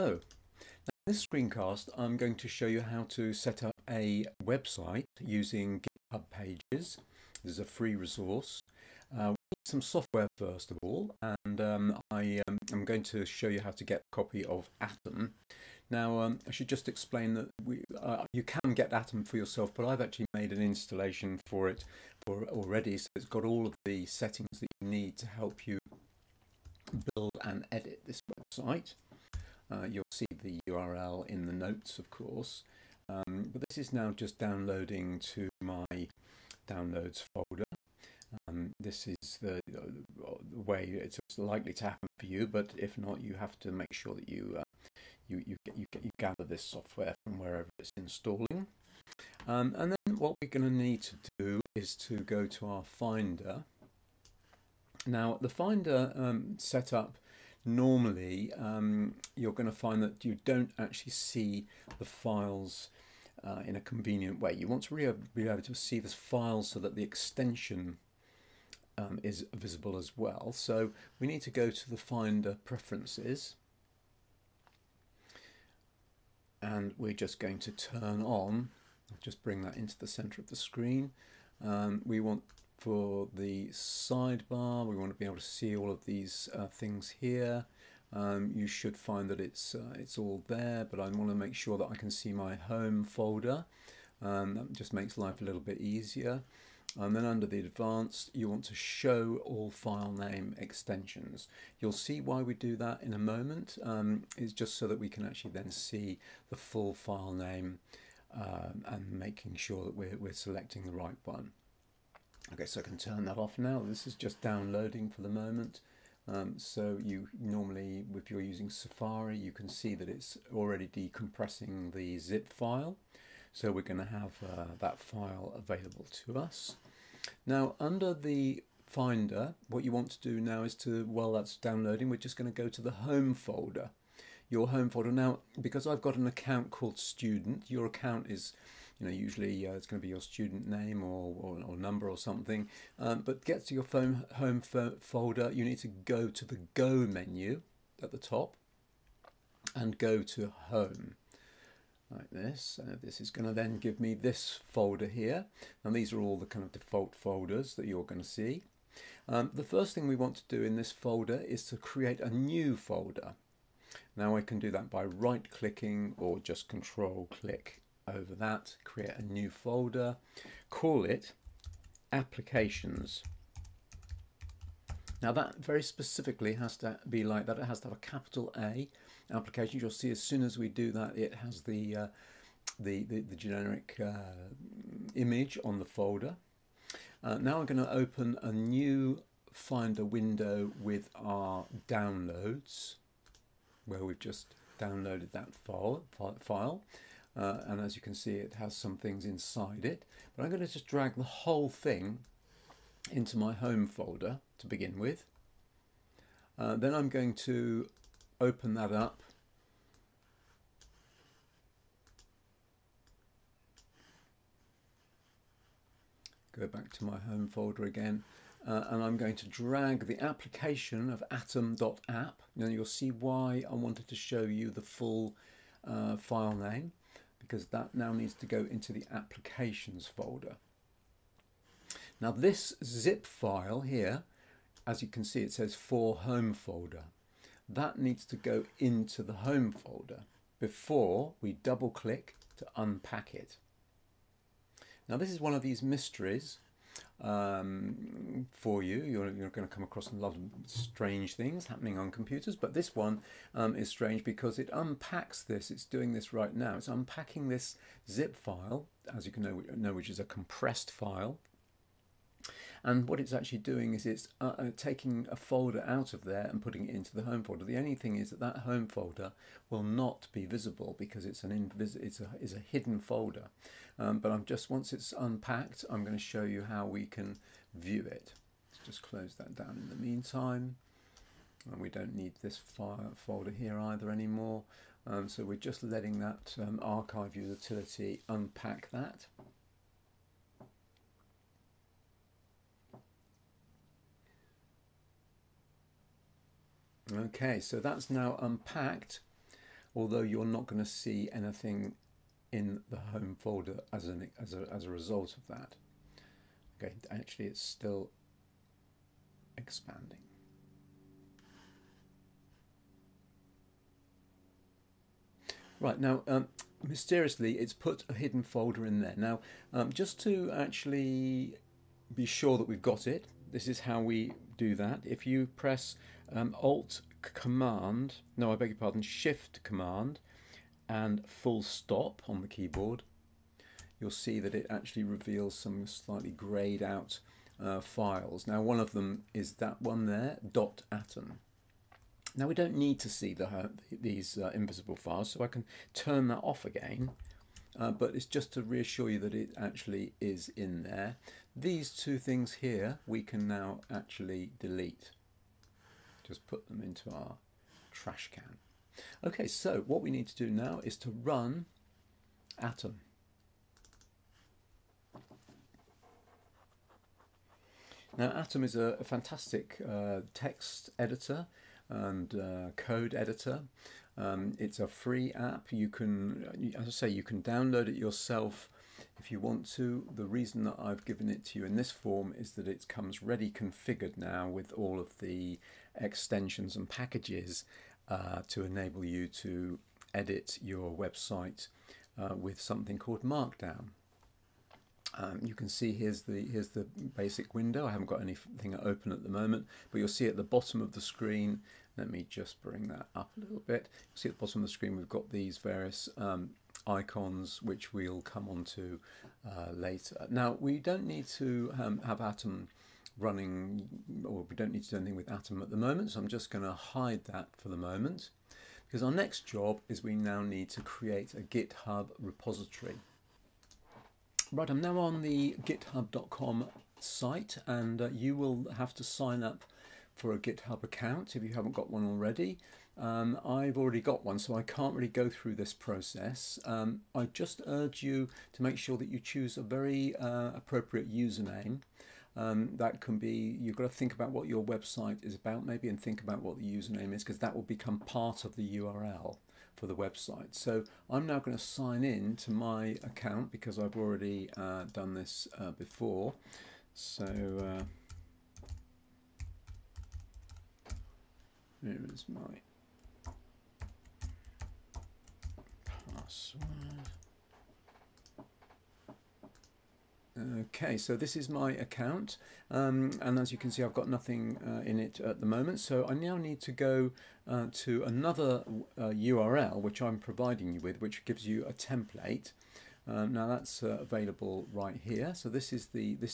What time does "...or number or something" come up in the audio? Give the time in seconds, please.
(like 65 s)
141 s.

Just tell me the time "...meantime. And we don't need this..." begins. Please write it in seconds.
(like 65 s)
279 s.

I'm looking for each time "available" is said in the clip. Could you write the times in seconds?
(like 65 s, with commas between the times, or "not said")
125 s, 484 s.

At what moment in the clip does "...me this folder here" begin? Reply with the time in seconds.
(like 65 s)
153 s.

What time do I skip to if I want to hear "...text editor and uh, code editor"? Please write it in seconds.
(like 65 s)
370 s.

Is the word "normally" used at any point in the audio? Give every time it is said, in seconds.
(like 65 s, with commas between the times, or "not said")
57 s, 117 s.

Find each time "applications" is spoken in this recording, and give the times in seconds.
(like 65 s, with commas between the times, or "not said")
172 s, 179 s, 220 s, 229 s.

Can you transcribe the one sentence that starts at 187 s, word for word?
Uh, now I'm going to open a new Finder window with our downloads, where we've just downloaded that file.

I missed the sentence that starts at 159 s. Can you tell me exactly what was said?
Um, the first thing we want to do in this folder is to create a new folder.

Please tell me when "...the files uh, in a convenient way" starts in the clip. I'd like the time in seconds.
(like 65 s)
61 s.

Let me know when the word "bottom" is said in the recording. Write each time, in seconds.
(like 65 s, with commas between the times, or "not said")
400 s, 404 s.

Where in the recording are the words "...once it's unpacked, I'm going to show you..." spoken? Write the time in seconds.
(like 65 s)
274 s.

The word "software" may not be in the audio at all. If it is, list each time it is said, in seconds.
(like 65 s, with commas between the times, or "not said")
9 s, 46 s.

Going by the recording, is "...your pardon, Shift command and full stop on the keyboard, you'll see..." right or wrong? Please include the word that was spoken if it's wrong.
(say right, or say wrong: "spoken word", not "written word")
right.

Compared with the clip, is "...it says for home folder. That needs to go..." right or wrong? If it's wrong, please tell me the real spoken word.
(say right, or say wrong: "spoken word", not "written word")
right.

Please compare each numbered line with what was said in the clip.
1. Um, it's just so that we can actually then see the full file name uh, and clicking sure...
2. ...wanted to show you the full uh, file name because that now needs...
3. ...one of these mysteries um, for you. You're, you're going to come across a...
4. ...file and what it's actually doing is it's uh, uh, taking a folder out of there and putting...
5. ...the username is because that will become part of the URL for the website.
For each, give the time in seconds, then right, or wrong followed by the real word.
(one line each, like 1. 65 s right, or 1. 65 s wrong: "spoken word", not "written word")
1. 103 s wrong: "making", not "clicking"
2. 223 s right
3. 245 s right
4. 260 s right
5. 446 s right.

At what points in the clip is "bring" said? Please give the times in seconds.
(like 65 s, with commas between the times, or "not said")
79 s, 402 s.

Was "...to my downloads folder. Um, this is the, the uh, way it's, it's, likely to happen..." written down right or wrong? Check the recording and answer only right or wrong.
right.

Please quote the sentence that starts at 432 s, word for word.
Um, I've already got one, so I can't really go through this process.